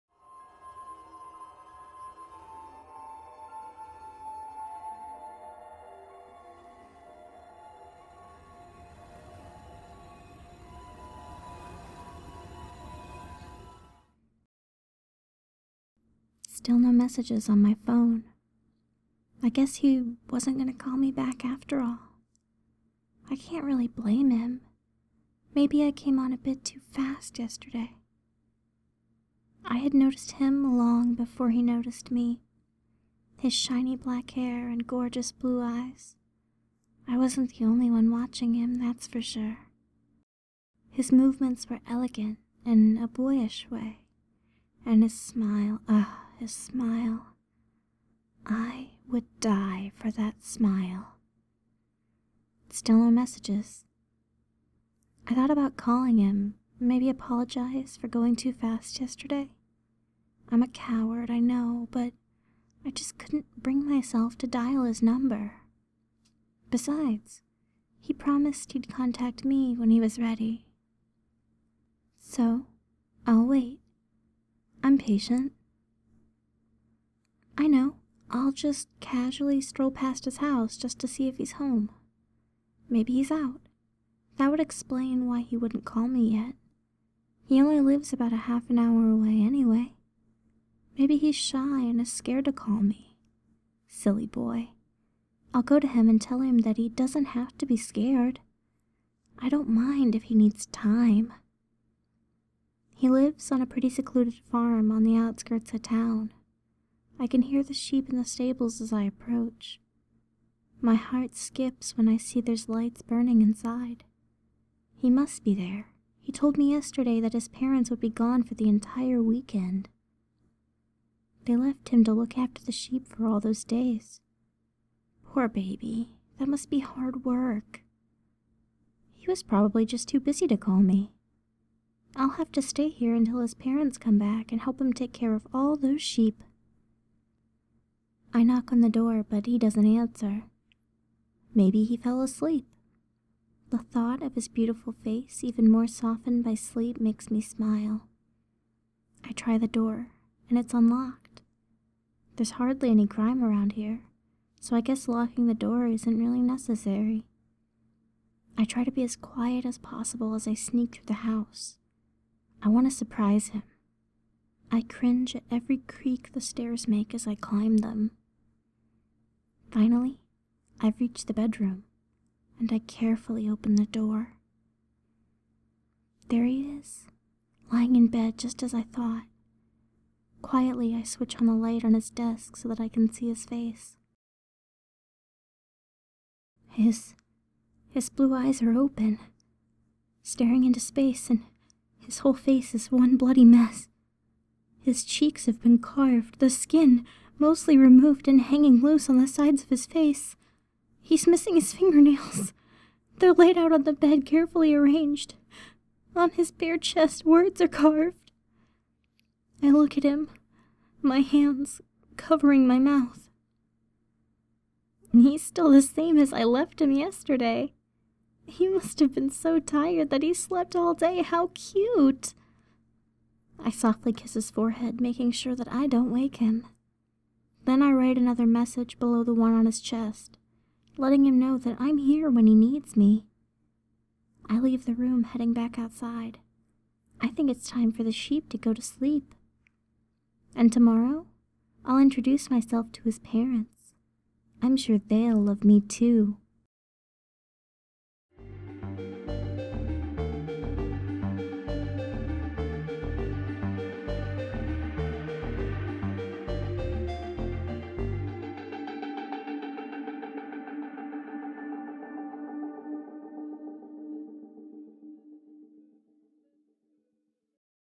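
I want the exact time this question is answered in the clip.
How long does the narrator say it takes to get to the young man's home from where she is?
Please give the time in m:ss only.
1:28.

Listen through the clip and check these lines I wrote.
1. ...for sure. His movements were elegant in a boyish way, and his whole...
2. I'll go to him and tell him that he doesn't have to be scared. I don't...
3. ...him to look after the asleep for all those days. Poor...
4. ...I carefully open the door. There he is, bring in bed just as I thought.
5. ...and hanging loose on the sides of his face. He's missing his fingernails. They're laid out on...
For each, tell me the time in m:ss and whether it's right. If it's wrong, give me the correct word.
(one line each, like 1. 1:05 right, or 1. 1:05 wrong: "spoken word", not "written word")
1. 0:39 wrong: "smile", not "whole"
2. 1:35 right
3. 2:01 wrong: "sheep", not "asleep"
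4. 2:52 wrong: "lying", not "bring"
5. 3:18 right.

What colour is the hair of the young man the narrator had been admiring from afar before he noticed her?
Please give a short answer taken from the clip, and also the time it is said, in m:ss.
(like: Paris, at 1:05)
black, at 0:33.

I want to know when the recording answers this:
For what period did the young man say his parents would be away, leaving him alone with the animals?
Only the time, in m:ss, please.
1:58.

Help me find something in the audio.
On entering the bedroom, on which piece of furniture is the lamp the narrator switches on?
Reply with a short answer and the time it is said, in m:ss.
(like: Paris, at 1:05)
his desk, at 3:01.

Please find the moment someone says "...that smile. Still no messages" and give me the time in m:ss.
0:50.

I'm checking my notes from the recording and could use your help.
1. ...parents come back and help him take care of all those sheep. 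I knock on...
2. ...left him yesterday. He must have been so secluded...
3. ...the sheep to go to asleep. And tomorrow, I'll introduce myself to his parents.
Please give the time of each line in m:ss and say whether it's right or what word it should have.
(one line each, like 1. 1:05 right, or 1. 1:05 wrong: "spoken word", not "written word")
1. 2:13 right
2. 3:36 wrong: "tired", not "secluded"
3. 3:58 wrong: "sleep", not "asleep".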